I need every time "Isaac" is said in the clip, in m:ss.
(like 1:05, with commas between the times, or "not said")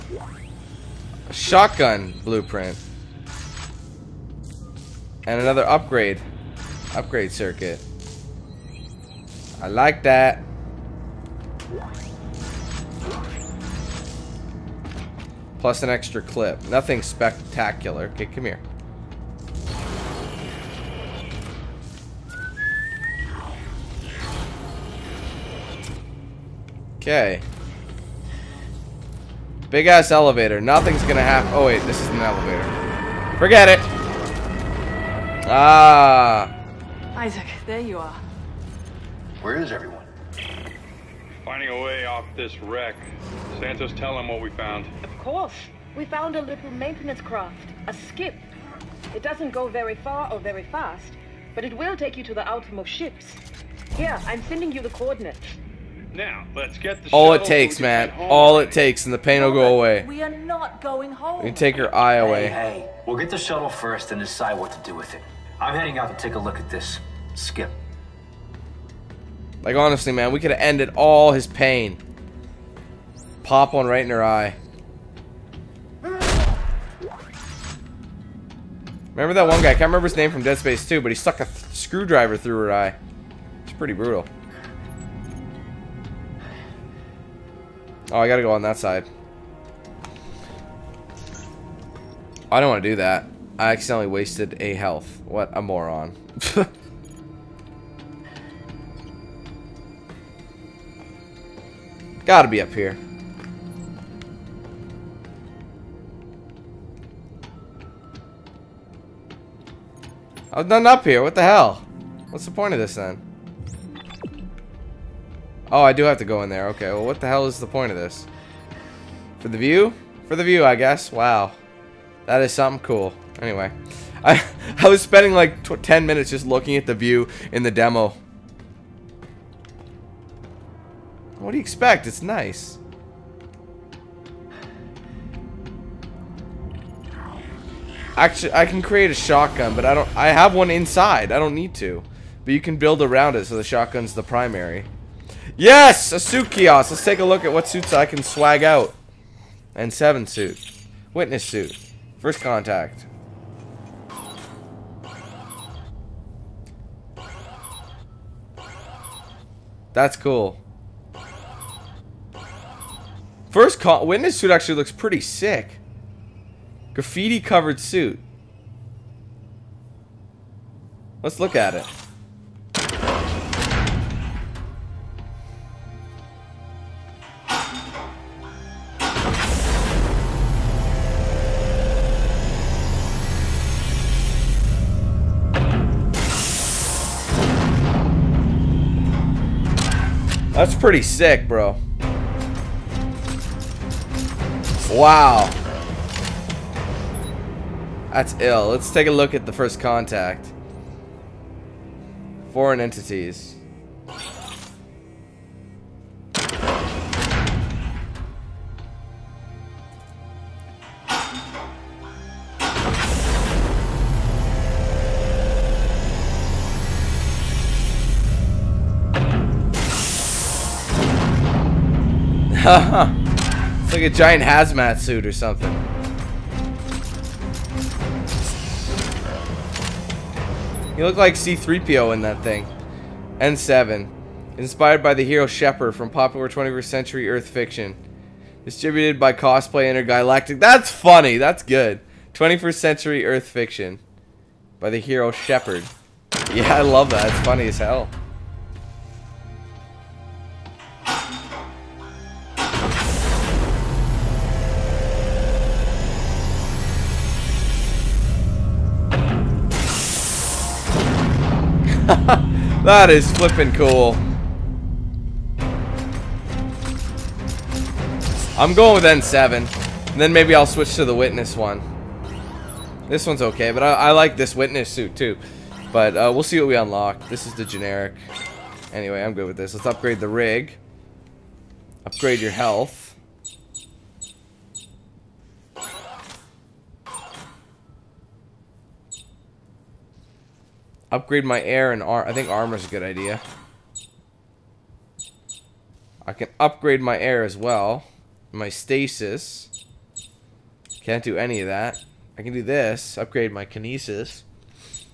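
0:37.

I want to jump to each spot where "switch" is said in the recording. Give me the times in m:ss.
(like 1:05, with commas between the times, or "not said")
4:30.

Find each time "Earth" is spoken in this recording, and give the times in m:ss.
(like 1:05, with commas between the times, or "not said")
3:57, 4:03.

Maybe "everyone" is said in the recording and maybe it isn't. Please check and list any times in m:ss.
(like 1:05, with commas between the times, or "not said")
0:39.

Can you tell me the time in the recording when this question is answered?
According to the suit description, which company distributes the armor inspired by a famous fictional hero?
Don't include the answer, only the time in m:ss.
3:59.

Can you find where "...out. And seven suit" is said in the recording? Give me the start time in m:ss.
2:28.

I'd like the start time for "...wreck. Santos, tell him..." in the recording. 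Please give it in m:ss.
0:42.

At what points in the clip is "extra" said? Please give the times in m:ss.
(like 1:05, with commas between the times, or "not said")
0:15.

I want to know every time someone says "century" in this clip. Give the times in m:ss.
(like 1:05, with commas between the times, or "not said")
3:56, 4:02.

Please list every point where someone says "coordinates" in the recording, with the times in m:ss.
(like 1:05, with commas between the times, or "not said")
0:54.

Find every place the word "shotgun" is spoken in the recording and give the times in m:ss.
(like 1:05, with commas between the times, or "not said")
0:01, 2:19, 2:23.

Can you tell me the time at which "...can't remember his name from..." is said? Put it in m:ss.
1:19.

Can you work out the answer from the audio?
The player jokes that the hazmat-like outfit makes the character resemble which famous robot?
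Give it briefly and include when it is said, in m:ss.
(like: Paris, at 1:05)
C-3PO, at 3:51.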